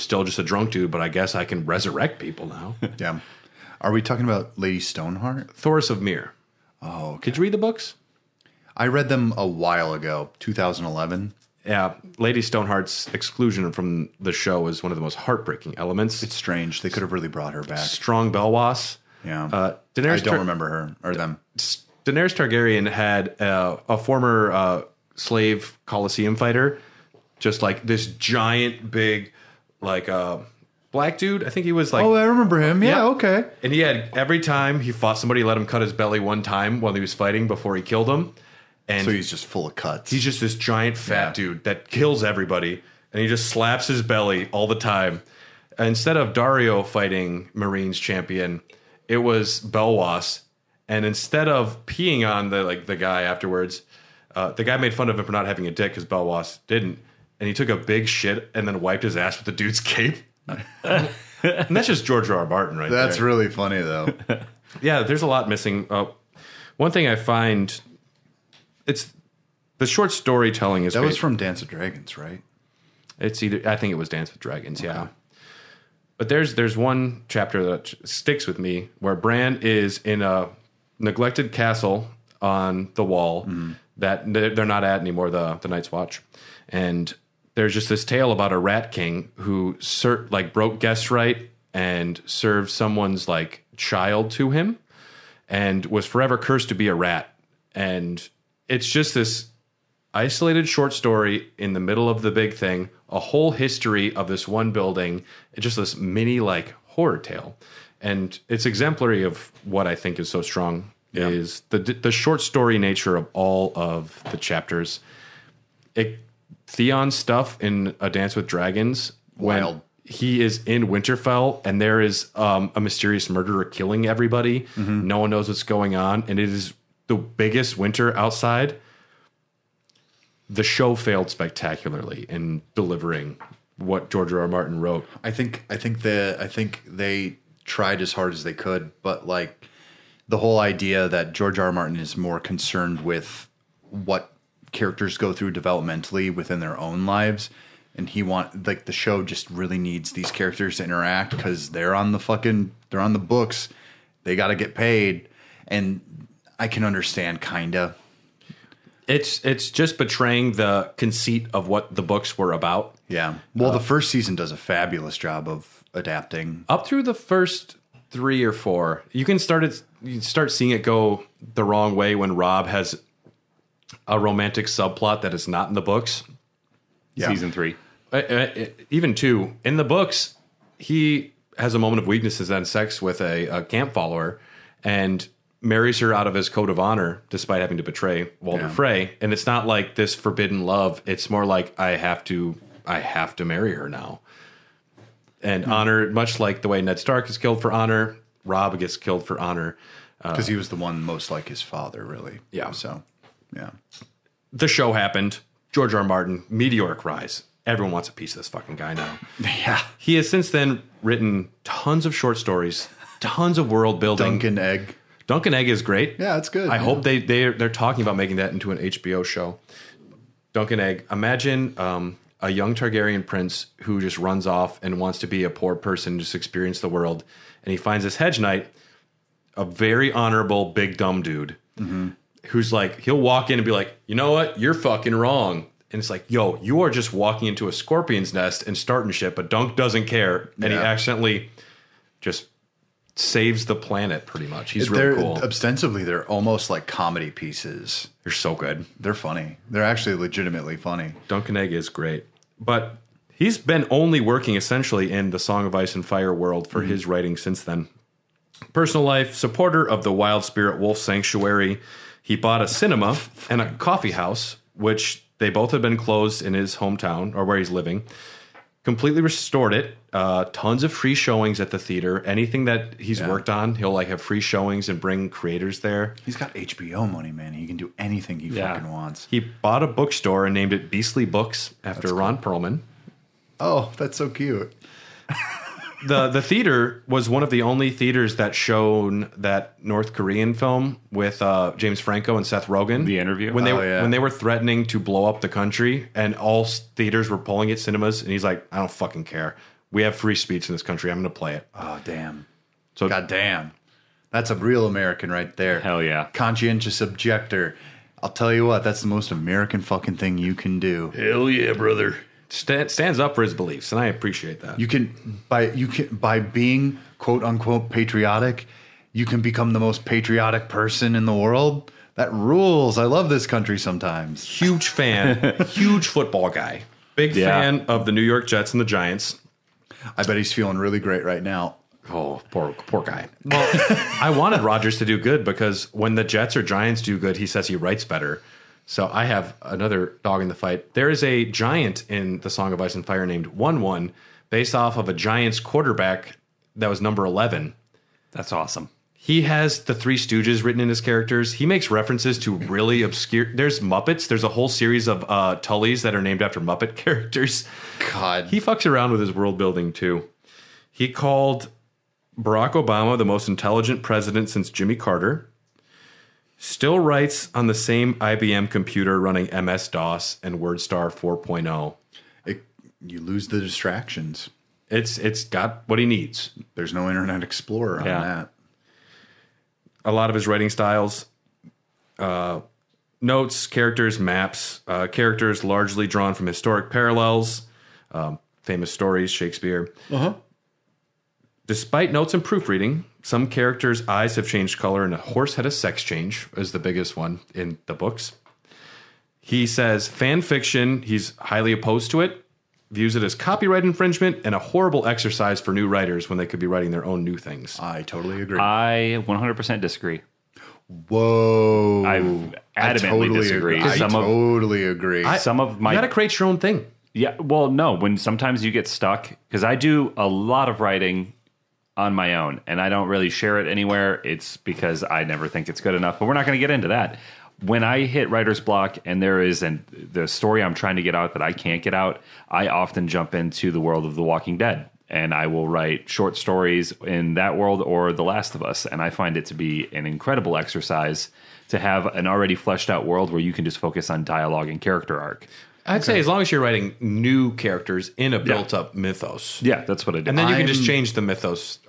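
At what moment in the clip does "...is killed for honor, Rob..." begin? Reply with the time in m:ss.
3:17.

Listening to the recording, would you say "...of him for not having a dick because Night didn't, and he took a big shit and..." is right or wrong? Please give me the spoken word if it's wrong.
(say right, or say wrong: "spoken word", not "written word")
wrong: "Belwas", not "Night".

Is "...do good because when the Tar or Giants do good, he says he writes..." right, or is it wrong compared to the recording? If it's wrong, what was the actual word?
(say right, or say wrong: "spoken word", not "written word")
wrong: "Jets", not "Tar".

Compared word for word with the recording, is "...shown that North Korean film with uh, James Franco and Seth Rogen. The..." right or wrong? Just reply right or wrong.
right.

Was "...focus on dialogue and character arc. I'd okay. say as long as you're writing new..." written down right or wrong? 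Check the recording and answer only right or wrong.
right.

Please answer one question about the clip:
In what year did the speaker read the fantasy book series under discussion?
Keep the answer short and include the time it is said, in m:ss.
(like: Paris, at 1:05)
2011, at 0:10.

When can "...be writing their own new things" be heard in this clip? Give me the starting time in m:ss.
6:46.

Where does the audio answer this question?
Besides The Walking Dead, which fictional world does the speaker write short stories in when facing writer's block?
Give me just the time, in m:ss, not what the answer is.
7:18.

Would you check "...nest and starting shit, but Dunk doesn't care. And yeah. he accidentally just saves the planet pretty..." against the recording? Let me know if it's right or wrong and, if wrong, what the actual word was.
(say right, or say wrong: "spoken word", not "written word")
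right.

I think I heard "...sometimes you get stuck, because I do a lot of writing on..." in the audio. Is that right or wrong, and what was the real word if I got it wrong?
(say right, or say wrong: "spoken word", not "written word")
right.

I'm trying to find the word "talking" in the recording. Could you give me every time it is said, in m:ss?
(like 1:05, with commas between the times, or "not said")
0:04, 3:37.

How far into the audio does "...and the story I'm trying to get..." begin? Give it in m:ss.
7:09.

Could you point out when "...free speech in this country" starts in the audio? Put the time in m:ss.
5:00.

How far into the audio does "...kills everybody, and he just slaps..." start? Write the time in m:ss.
0:41.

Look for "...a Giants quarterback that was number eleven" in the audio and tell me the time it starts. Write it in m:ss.
5:45.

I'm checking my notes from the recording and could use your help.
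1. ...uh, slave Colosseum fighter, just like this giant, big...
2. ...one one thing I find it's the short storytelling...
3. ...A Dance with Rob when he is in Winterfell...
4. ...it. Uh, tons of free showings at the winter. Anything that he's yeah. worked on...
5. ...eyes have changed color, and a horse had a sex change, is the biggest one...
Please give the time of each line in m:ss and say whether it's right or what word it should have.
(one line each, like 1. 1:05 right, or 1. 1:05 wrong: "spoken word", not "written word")
1. 0:24 right
2. 1:06 right
3. 1:57 wrong: "Dragons", not "Rob"
4. 4:29 wrong: "theater", not "winter"
5. 6:34 right.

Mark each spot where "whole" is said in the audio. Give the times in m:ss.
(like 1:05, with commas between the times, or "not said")
1:43, 2:20, 5:54.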